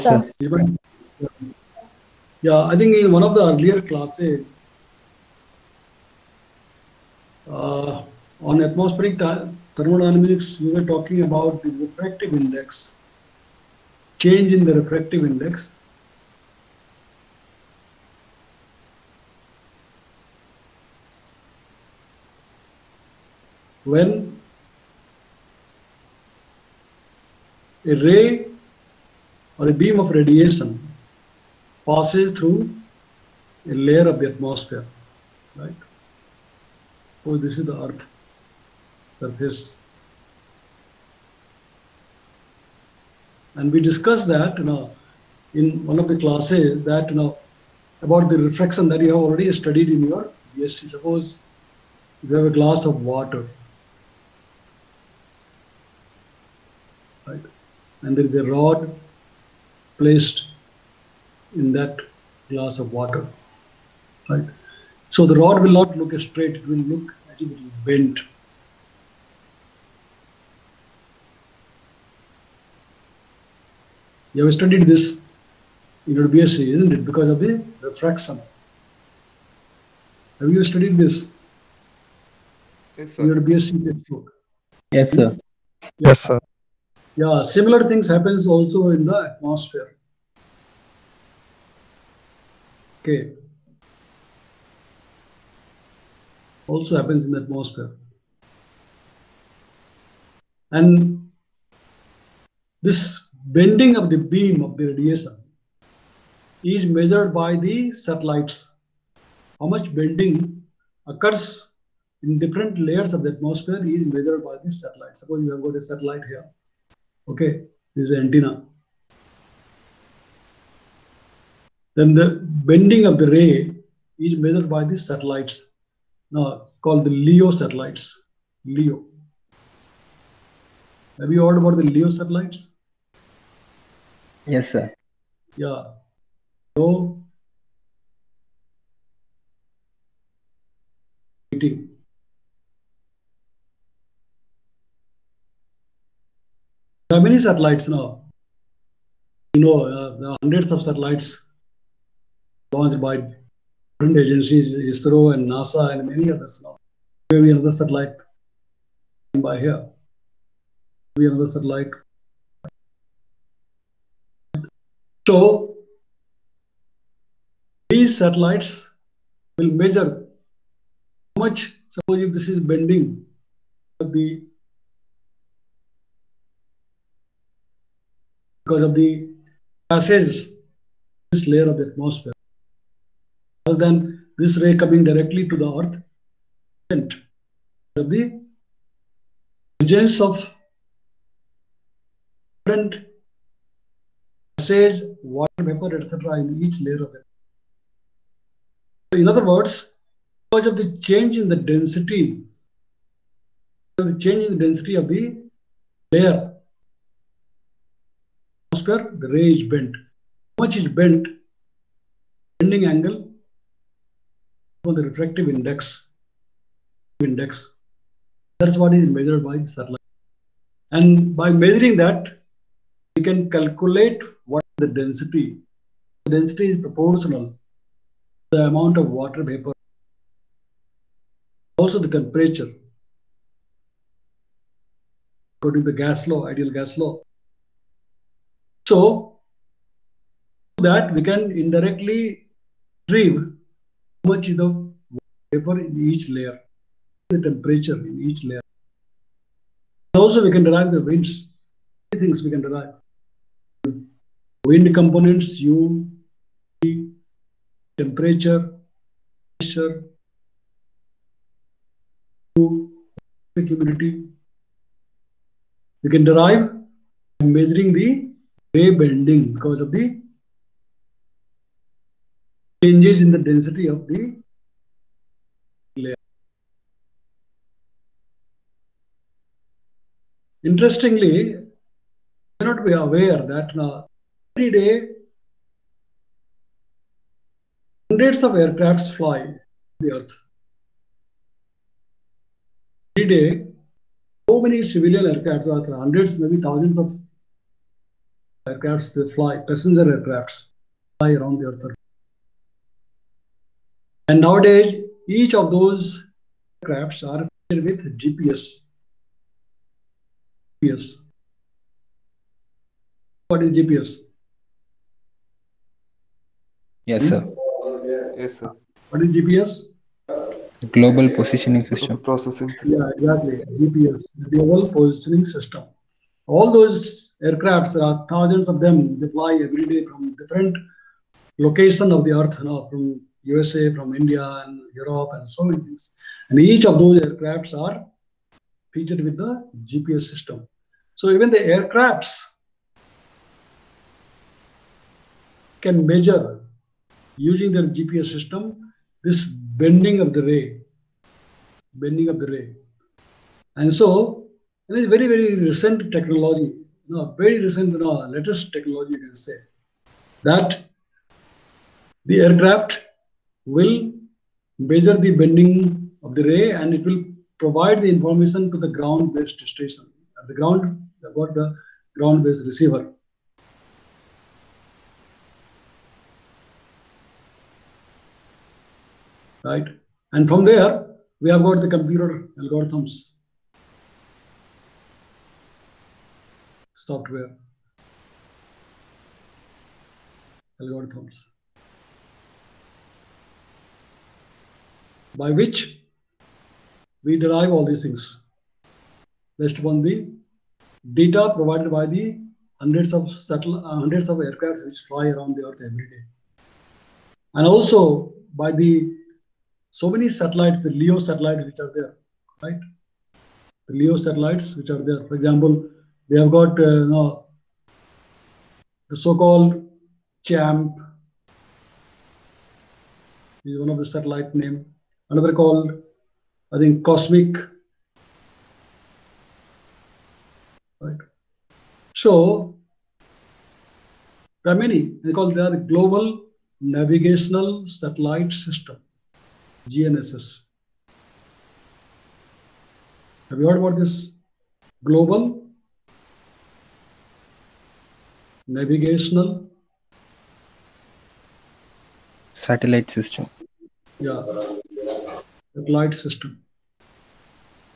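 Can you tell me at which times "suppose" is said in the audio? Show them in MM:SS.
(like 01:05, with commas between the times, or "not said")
00:50, 01:55, 02:51.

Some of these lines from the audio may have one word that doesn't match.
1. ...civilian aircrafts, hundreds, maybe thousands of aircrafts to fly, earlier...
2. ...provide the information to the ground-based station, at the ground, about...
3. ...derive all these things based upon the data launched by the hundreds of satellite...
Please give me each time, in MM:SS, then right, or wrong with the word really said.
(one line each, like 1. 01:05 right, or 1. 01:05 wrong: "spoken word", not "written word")
1. 04:54 wrong: "passenger", not "earlier"
2. 06:07 right
3. 06:37 wrong: "provided", not "launched".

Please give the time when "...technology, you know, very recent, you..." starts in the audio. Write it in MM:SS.
05:56.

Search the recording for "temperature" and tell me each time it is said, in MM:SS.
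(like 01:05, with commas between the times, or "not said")
03:52, 04:07, 04:17.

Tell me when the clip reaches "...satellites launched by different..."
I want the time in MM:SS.
02:30.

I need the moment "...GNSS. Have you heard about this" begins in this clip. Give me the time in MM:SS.
07:19.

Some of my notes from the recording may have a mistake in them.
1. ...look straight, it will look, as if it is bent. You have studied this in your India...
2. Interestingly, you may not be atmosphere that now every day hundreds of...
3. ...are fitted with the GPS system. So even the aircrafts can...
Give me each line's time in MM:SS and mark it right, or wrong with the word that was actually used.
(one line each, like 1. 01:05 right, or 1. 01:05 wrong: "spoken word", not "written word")
1. 01:05 wrong: "BSc", not "India"
2. 04:40 wrong: "aware", not "atmosphere"
3. 05:37 right.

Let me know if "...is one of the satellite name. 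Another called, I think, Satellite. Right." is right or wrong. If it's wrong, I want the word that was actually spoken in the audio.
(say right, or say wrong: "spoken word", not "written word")
wrong: "Cosmic", not "Satellite".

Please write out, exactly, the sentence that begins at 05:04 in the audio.
And nowadays, each of those aircrafts are equipped with GPS.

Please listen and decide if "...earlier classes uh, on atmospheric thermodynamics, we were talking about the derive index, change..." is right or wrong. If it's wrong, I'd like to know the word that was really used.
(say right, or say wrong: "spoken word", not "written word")
wrong: "refractive", not "derive".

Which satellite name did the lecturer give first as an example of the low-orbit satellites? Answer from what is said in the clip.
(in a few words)
CHAMP.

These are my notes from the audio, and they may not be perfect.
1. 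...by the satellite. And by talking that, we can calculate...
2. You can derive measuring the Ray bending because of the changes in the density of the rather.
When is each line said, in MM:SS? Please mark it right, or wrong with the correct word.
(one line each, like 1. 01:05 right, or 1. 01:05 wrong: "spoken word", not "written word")
1. 03:39 wrong: "measuring", not "talking"
2. 04:26 wrong: "layer", not "rather".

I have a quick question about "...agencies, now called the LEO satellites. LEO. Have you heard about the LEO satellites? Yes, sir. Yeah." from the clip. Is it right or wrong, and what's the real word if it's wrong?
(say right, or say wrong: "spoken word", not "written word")
wrong: "satellites", not "agencies".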